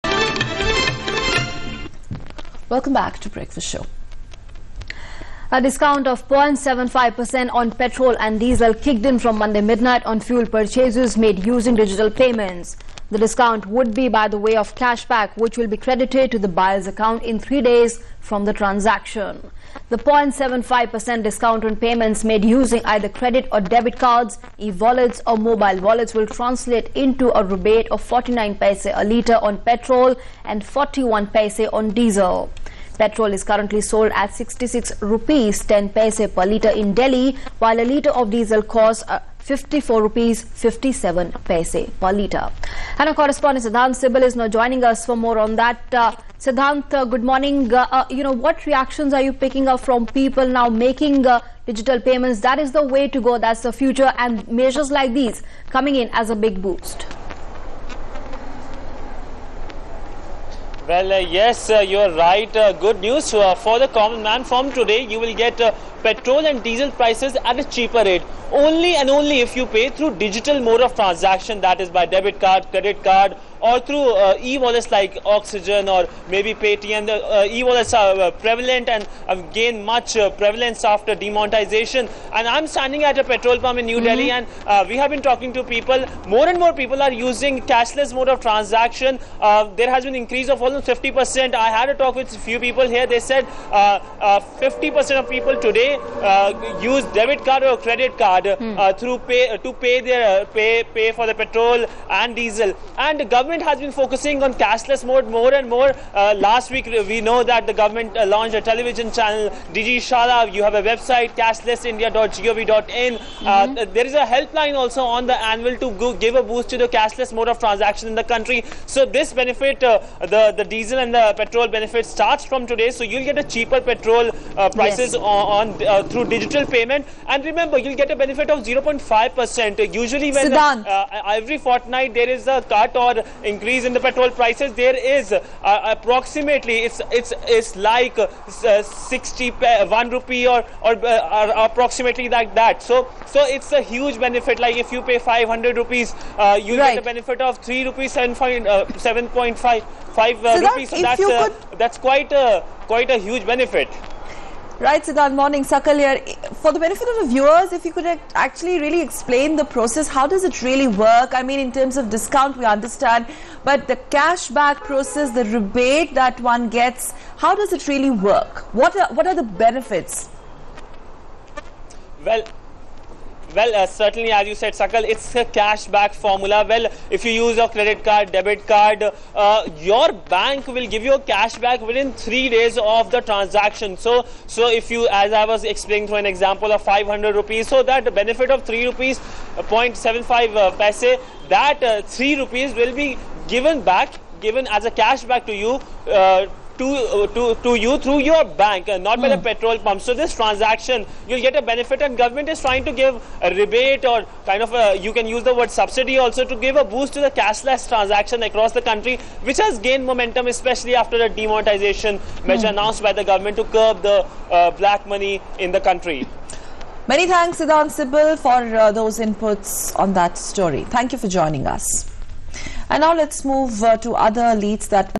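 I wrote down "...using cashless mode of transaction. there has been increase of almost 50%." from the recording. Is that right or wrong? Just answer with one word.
right.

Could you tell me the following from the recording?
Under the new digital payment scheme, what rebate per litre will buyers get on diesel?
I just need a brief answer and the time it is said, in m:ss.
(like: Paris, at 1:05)
41 paise, at 0:30.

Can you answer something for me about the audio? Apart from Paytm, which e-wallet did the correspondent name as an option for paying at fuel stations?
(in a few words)
Oxigen.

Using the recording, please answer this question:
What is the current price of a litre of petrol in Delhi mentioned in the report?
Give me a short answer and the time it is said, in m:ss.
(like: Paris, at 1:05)
66 rupees 10 paise, at 0:34.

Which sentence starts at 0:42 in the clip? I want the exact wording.
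And our correspondent Sidhant Sibal is now joining us for more on that.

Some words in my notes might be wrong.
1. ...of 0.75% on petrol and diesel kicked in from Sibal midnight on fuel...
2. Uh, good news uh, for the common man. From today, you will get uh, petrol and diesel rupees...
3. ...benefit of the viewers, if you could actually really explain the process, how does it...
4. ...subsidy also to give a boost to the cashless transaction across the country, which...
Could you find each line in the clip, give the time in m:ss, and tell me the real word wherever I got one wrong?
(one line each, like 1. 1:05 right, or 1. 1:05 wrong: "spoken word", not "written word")
1. 0:06 wrong: "Monday", not "Sibal"
2. 1:02 wrong: "prices", not "rupees"
3. 2:36 right
4. 3:25 right.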